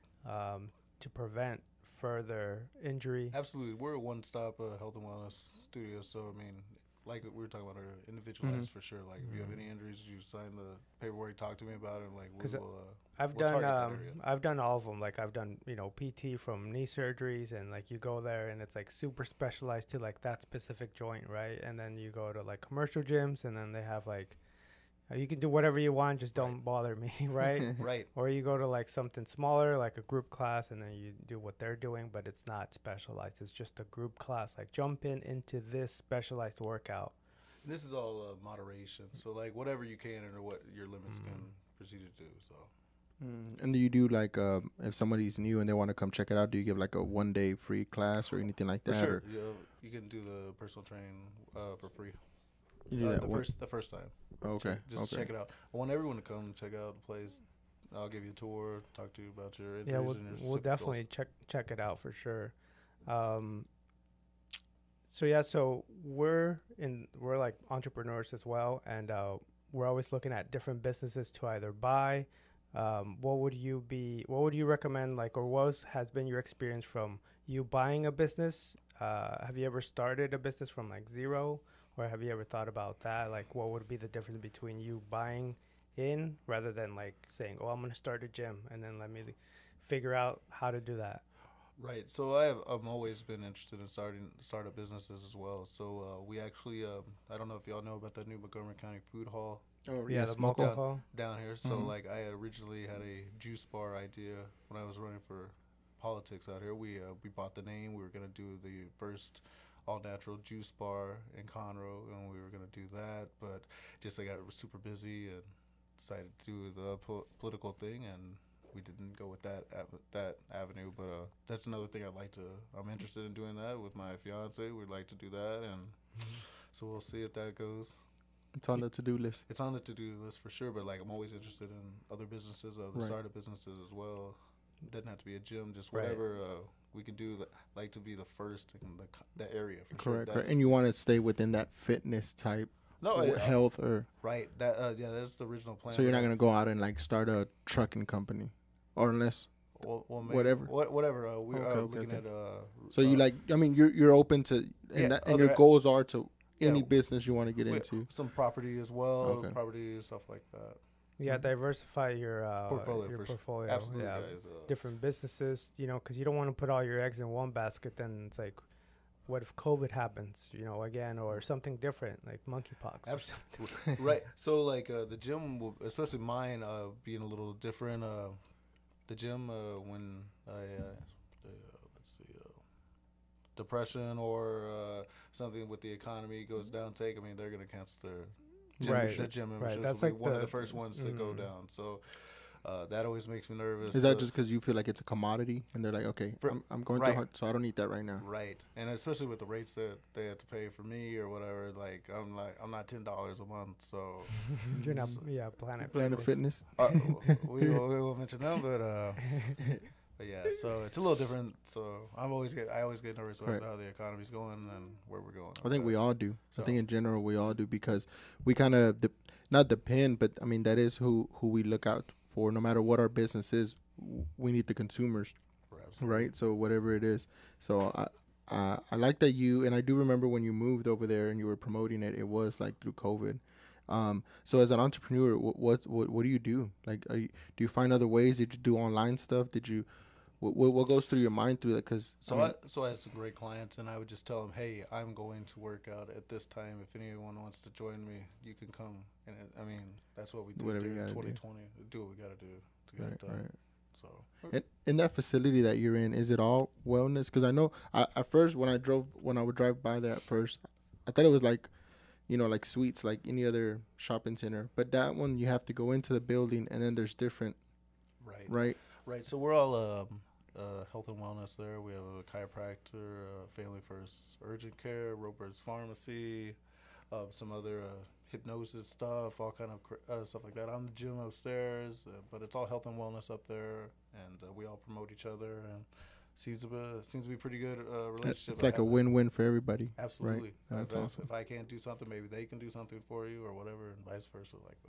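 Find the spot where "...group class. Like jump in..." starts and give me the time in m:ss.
0:33.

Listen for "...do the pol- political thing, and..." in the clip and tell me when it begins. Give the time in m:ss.
1:56.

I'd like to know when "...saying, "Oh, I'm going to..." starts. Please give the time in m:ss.
1:27.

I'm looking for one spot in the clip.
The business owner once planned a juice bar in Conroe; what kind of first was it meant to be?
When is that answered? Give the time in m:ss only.
1:49.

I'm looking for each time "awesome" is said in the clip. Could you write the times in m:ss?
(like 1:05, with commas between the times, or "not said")
4:51.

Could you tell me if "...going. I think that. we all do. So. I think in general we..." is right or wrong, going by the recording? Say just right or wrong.
right.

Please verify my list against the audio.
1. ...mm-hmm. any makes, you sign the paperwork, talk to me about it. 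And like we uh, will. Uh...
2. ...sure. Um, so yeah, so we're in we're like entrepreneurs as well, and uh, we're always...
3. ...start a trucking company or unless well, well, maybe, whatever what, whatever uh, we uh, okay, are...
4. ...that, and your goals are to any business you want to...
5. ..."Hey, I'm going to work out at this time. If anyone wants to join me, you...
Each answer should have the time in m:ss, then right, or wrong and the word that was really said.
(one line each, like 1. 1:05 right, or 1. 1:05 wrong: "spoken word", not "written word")
1. 0:09 wrong: "injuries", not "makes"
2. 1:02 right
3. 2:26 right
4. 2:35 right
5. 4:04 right.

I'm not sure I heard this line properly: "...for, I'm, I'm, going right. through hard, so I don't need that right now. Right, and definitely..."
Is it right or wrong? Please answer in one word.
wrong.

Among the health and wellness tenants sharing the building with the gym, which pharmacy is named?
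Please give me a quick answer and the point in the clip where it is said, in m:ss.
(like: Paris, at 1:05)
Roper's Pharmacy, at 4:35.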